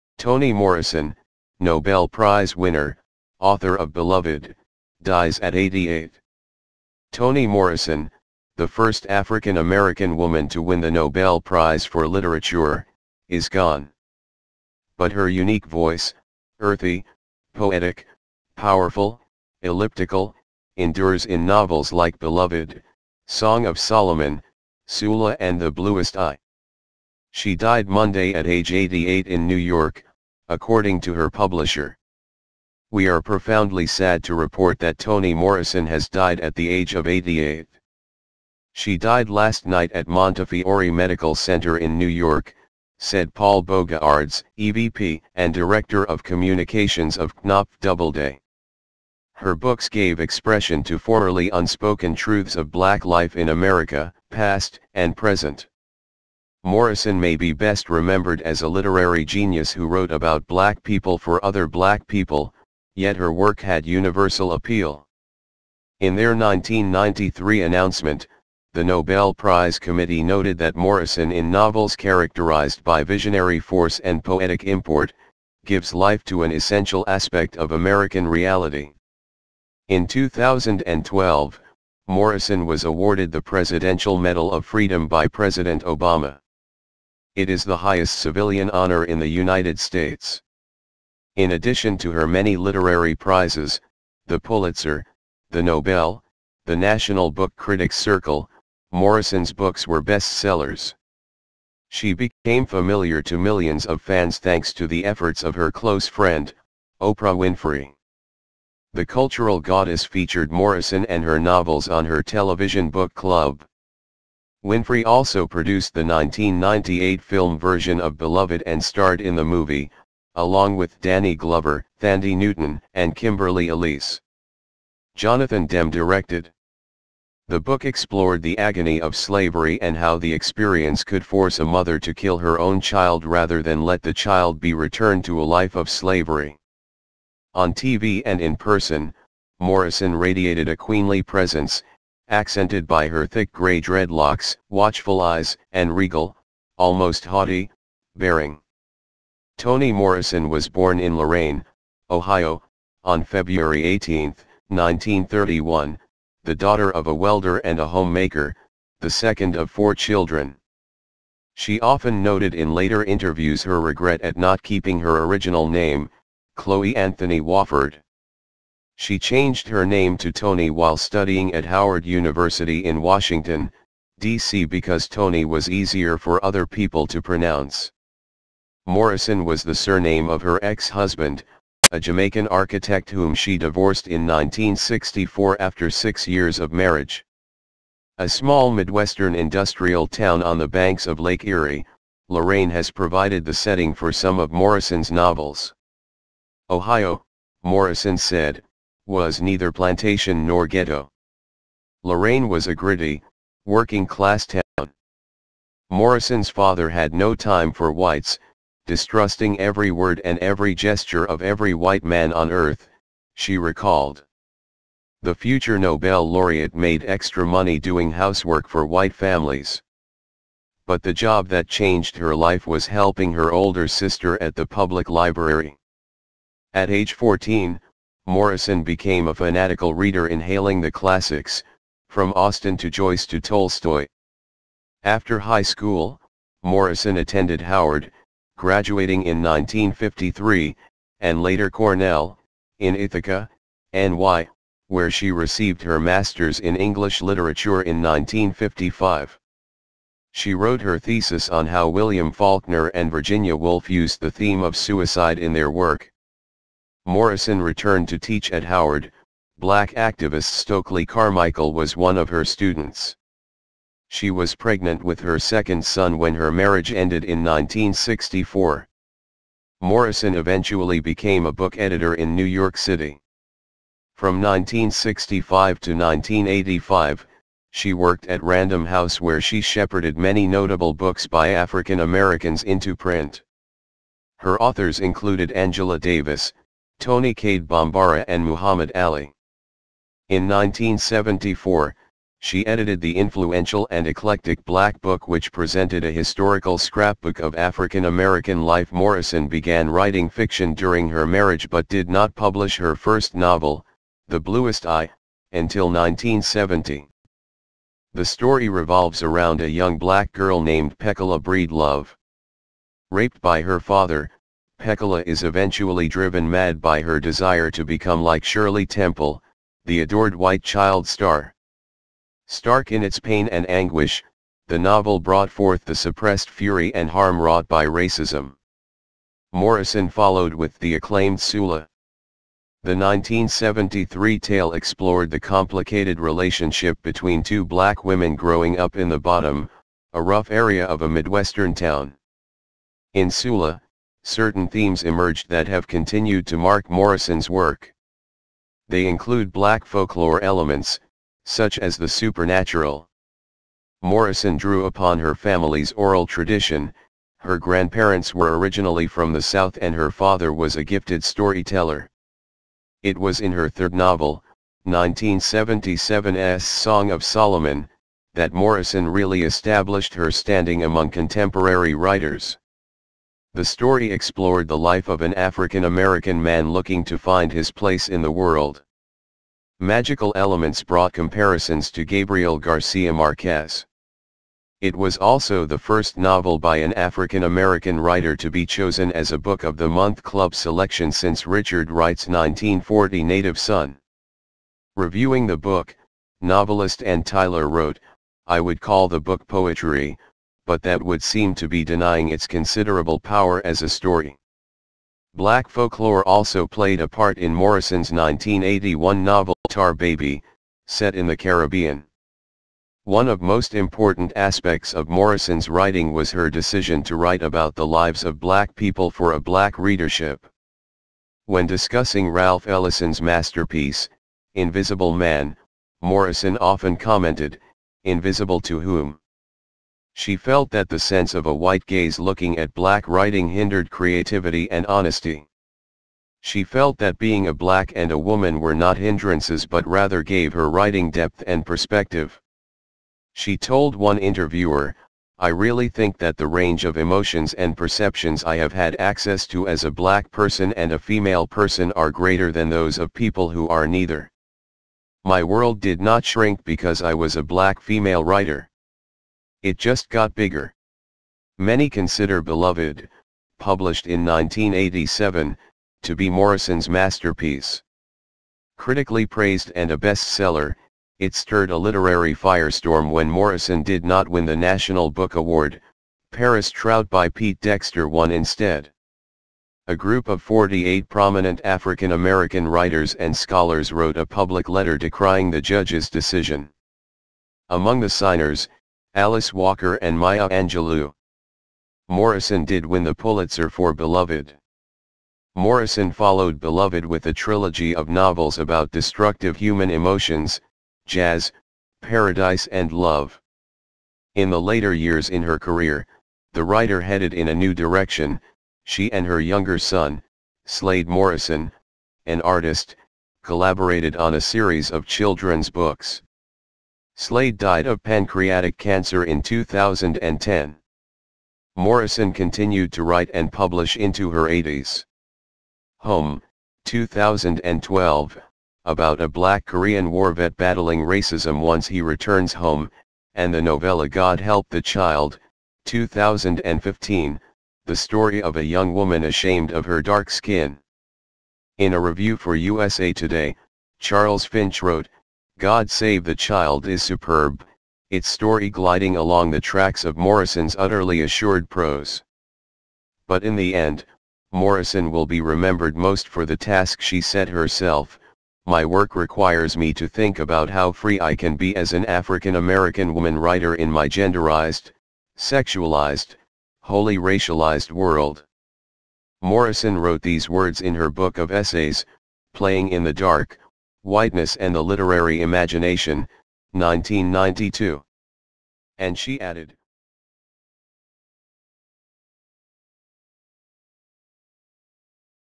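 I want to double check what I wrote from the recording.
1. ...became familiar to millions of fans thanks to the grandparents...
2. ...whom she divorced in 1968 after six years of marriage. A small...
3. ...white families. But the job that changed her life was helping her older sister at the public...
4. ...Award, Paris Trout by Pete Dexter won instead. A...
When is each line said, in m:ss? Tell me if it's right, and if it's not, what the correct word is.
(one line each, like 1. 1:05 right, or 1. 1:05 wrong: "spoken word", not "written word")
1. 1:42 wrong: "efforts", not "grandparents"
2. 3:03 wrong: "1964", not "1968"
3. 3:38 right
4. 7:55 right.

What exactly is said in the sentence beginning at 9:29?
Morrison wrote these words in her book of essays, Playing in the Dark, Whiteness and the Literary Imagination, 1992.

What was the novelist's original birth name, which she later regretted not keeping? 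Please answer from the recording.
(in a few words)
Chloe Anthony Wofford.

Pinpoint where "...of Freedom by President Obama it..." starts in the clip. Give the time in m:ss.
1:24.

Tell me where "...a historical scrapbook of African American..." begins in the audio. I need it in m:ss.
4:56.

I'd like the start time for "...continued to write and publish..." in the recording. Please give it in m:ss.
8:42.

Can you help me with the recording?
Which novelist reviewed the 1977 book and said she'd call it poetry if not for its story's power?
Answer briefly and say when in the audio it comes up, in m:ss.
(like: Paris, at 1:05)
Anne Tyler, at 6:37.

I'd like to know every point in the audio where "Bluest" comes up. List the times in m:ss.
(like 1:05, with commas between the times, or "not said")
0:25, 5:04.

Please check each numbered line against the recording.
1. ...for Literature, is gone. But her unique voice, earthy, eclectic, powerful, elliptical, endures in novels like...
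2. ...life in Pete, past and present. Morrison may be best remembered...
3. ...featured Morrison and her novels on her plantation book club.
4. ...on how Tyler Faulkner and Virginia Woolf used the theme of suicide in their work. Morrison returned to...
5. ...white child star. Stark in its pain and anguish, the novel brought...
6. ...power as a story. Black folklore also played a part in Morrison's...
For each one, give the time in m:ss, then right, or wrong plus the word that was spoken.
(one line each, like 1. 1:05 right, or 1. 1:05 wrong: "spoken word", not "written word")
1. 0:11 wrong: "poetic", not "eclectic"
2. 0:53 wrong: "America", not "Pete"
3. 1:50 wrong: "television", not "plantation"
4. 4:11 wrong: "William", not "Tyler"
5. 5:20 right
6. 6:43 right.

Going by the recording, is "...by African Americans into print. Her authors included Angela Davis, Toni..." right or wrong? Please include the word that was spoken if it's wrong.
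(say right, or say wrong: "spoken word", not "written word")
right.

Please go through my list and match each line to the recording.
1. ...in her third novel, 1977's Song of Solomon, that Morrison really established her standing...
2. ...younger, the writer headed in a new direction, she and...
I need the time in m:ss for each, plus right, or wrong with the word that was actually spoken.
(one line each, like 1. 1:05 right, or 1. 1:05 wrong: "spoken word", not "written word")
1. 6:03 right
2. 8:25 wrong: "career", not "younger".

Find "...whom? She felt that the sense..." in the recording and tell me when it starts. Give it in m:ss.
7:08.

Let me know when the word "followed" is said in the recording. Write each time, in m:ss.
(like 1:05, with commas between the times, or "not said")
5:30, 8:16.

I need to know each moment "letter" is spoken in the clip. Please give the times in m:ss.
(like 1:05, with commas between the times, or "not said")
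8:04.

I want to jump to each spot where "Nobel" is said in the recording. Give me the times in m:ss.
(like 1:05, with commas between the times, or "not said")
0:01, 0:10, 1:08, 1:35, 3:35.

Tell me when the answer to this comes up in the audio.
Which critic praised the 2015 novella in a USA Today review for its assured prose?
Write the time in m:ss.
9:03.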